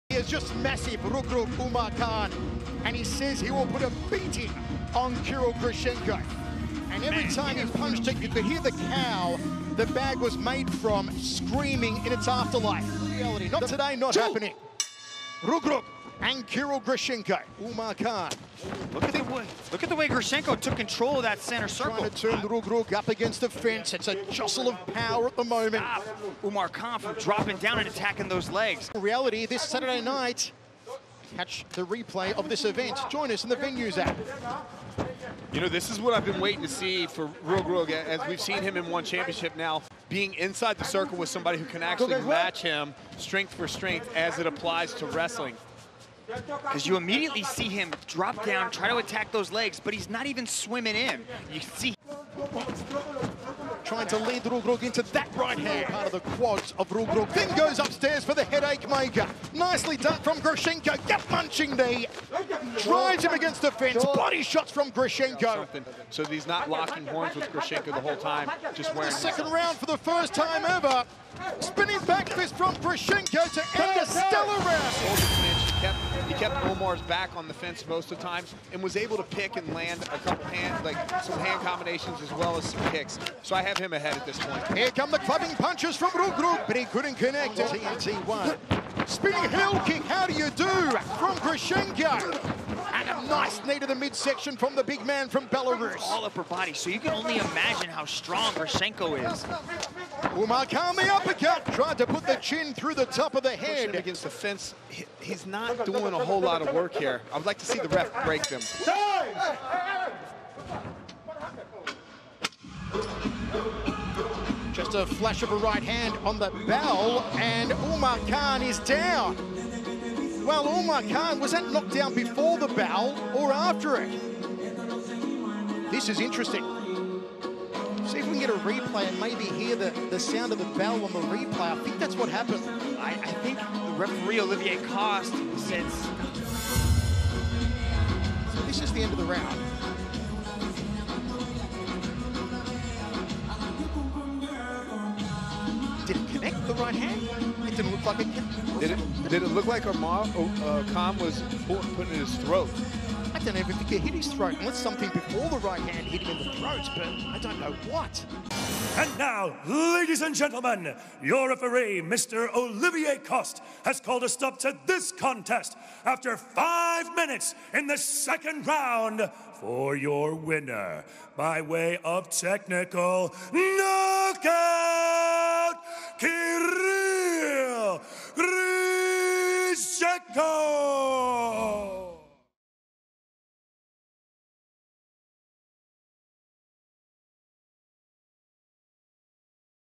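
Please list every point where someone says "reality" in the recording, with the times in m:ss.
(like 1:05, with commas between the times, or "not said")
0:13, 0:29.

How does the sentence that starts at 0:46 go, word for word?
Because you immediately see him drop down, try to attack those legs, but he's not even swimming in.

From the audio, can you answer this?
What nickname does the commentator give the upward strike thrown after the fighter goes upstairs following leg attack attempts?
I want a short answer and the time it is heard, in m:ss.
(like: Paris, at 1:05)
headache maker, at 0:58.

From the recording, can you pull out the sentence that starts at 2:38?
And now, ladies and gentlemen, your referee, Mr.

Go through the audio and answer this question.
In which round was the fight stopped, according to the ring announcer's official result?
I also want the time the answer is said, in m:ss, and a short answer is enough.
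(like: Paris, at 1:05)
Second round, at 2:47.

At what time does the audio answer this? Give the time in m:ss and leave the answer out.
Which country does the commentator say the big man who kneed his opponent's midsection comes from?
1:35.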